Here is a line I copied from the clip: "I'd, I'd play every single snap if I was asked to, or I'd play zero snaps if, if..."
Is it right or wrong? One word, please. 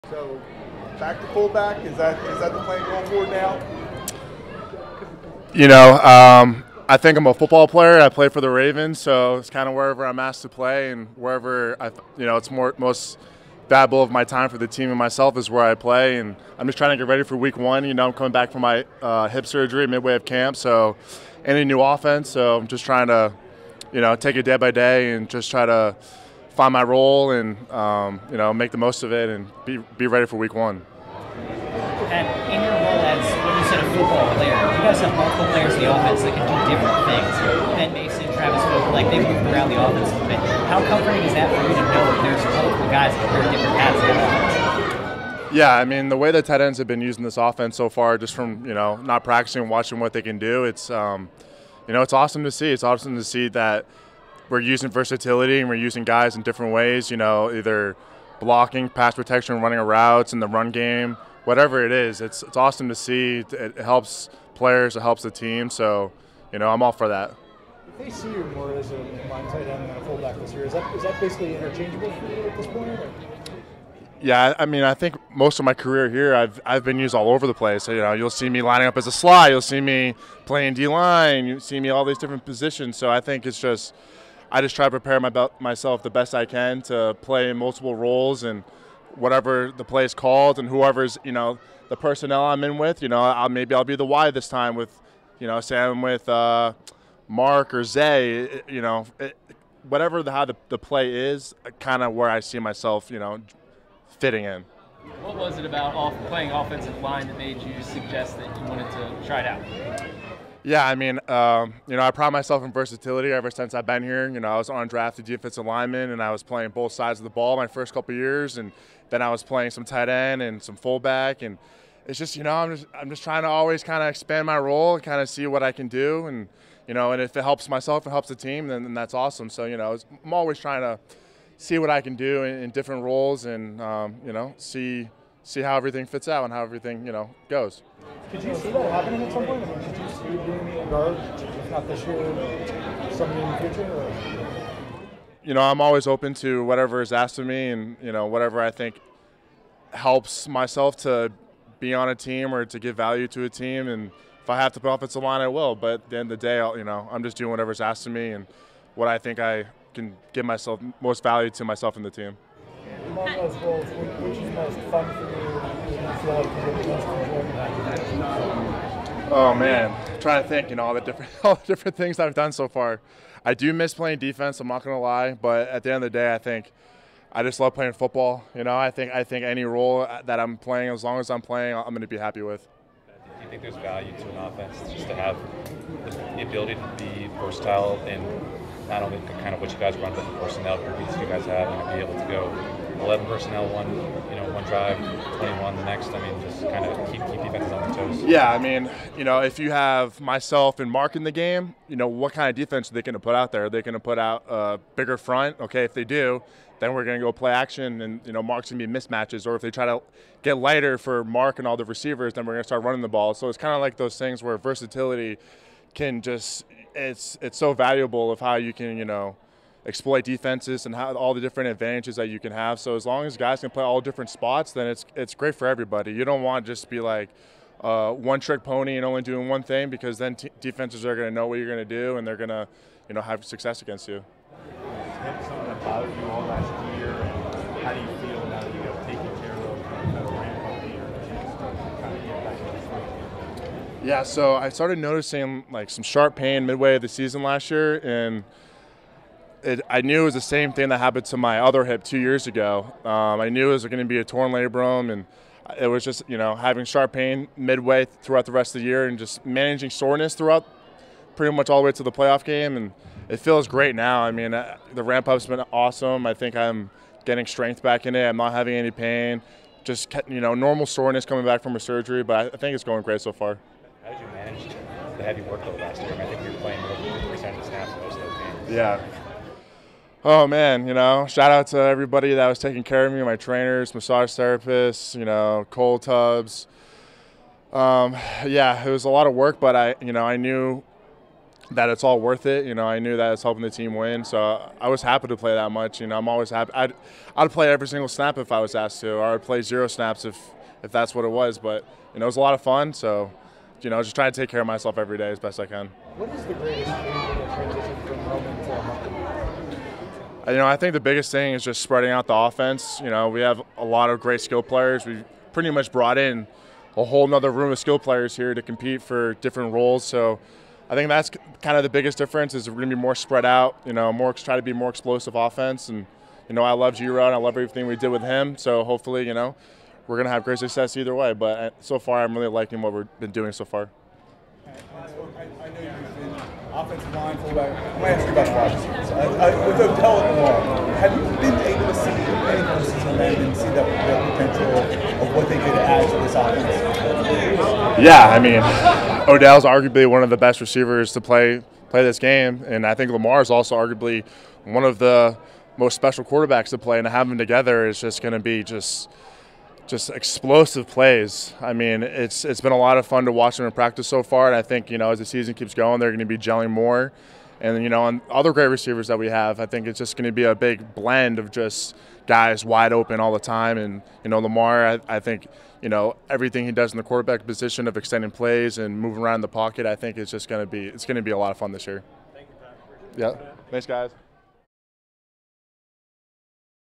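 right.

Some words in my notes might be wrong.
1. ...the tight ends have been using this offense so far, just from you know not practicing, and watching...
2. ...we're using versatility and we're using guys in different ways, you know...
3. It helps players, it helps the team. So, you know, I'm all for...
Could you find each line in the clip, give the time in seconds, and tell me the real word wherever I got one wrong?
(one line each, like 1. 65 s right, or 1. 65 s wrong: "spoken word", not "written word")
1. 46 s right
2. 54 s right
3. 63 s right.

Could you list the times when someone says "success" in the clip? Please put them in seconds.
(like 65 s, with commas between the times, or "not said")
233 s, 330 s.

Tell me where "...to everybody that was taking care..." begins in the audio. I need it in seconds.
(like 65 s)
281 s.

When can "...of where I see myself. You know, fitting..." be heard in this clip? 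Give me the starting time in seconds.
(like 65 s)
102 s.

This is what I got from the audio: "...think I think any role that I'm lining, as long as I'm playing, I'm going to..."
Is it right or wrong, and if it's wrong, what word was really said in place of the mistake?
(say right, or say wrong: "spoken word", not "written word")
wrong: "playing", not "lining".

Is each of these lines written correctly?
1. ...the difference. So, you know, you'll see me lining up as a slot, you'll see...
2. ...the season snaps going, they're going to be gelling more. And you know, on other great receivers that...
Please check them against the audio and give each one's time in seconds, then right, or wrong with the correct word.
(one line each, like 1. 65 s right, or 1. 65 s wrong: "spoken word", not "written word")
1. 77 s wrong: "place", not "difference"
2. 365 s wrong: "keeps", not "snaps".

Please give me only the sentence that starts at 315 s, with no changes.
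We've pretty much brought in a whole nother room of skill players here to compete for different roles.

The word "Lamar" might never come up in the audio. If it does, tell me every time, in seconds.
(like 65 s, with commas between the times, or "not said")
353 s, 374 s.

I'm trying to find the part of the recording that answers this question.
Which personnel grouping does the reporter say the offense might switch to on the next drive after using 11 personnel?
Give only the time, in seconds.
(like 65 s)
195 s.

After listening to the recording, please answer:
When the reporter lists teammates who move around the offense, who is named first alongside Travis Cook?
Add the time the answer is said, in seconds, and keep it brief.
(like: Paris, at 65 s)
Ben Mason, at 37 s.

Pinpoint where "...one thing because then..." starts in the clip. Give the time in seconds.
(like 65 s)
229 s.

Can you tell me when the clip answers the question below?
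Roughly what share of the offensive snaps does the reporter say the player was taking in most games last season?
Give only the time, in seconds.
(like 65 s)
276 s.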